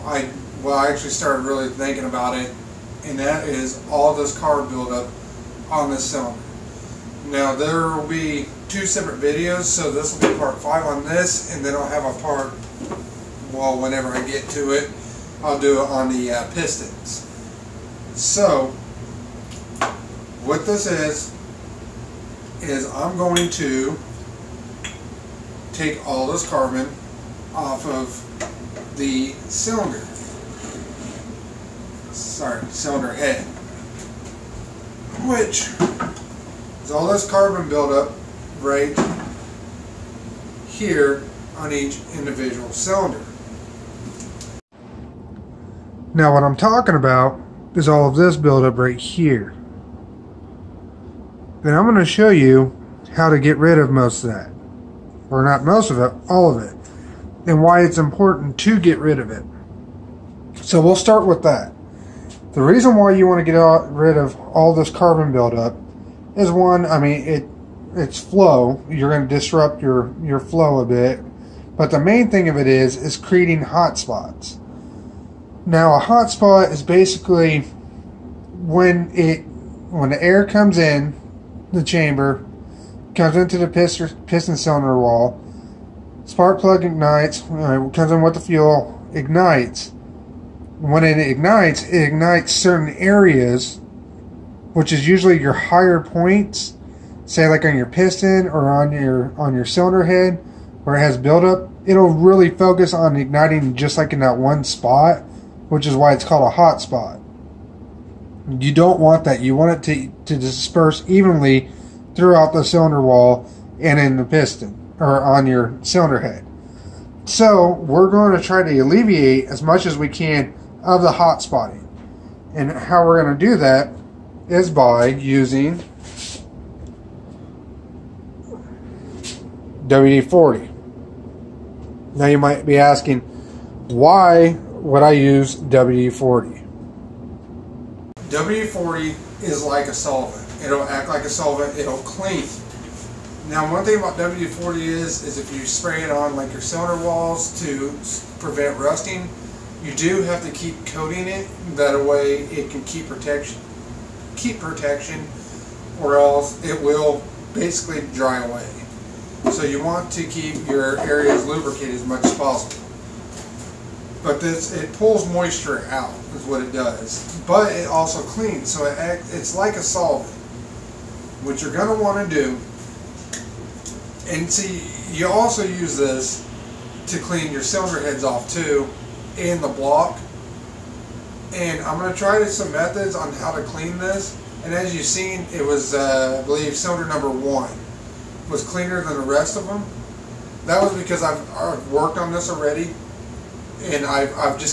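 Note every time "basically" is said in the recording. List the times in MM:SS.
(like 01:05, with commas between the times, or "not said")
01:16, 02:37.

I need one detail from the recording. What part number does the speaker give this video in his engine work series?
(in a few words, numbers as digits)
5.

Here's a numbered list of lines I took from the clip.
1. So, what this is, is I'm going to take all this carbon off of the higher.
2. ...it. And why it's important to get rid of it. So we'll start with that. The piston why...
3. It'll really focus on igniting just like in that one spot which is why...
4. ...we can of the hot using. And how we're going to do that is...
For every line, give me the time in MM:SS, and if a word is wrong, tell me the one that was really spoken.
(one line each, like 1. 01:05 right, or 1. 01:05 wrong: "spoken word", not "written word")
1. 00:18 wrong: "cylinder", not "higher"
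2. 00:56 wrong: "reason", not "piston"
3. 01:41 right
4. 01:59 wrong: "spotting", not "using".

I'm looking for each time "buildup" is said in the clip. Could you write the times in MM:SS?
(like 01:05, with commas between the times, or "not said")
00:04, 00:37, 00:48, 01:05, 01:41.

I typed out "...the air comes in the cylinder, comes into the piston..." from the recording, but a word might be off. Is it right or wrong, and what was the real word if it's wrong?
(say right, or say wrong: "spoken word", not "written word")
wrong: "chamber", not "cylinder".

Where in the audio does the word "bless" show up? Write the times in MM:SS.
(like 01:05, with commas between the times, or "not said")
not said.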